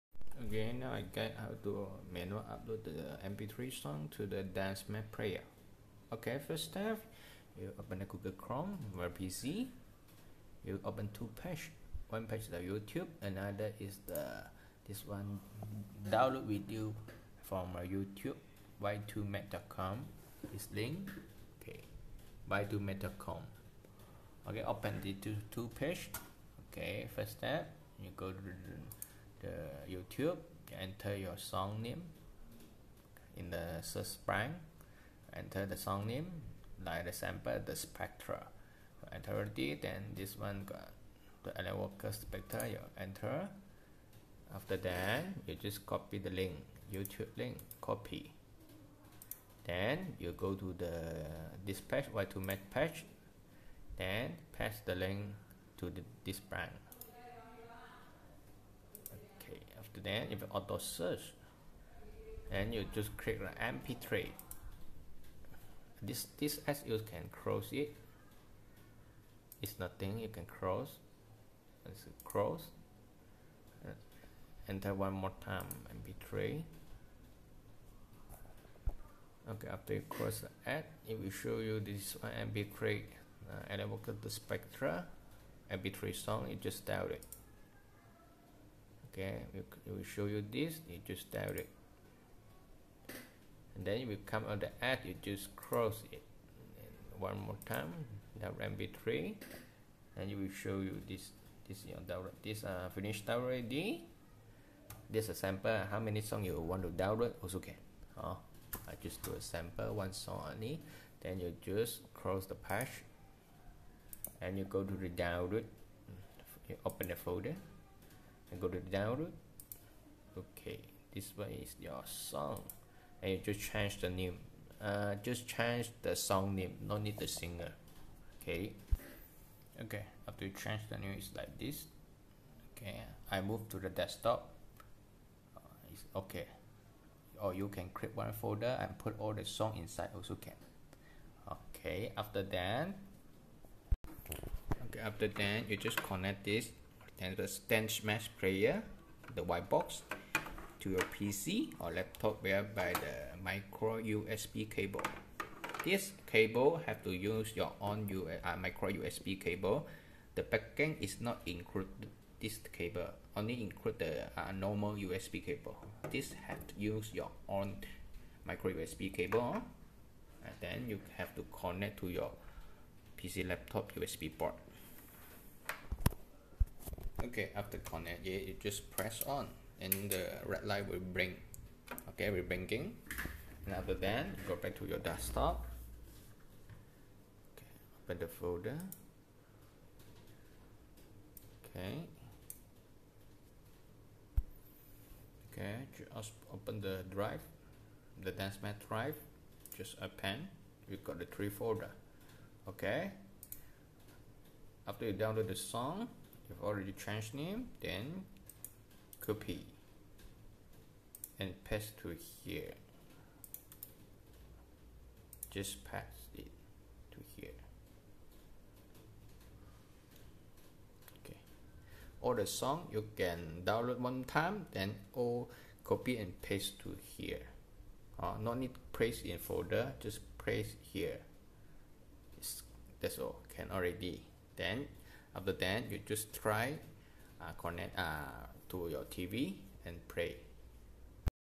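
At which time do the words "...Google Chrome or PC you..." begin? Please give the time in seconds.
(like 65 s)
8 s.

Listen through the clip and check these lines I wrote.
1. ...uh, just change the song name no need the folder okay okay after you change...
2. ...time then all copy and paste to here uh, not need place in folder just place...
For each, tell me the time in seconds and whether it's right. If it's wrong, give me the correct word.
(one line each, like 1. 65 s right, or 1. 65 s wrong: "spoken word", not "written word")
1. 124 s wrong: "singer", not "folder"
2. 224 s right.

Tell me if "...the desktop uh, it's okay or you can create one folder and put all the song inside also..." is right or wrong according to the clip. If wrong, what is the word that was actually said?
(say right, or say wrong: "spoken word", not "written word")
right.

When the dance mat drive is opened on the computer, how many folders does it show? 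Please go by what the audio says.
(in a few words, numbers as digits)
3.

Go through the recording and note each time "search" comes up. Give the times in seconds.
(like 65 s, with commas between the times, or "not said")
33 s, 60 s.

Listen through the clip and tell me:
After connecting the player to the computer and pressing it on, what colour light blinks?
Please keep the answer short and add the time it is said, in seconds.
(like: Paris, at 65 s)
Red, at 180 s.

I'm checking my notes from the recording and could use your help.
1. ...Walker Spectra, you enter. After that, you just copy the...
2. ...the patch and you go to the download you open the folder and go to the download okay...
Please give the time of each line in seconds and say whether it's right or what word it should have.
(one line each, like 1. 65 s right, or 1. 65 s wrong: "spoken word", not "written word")
1. 41 s right
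2. 112 s right.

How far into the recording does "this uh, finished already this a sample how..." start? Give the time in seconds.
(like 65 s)
102 s.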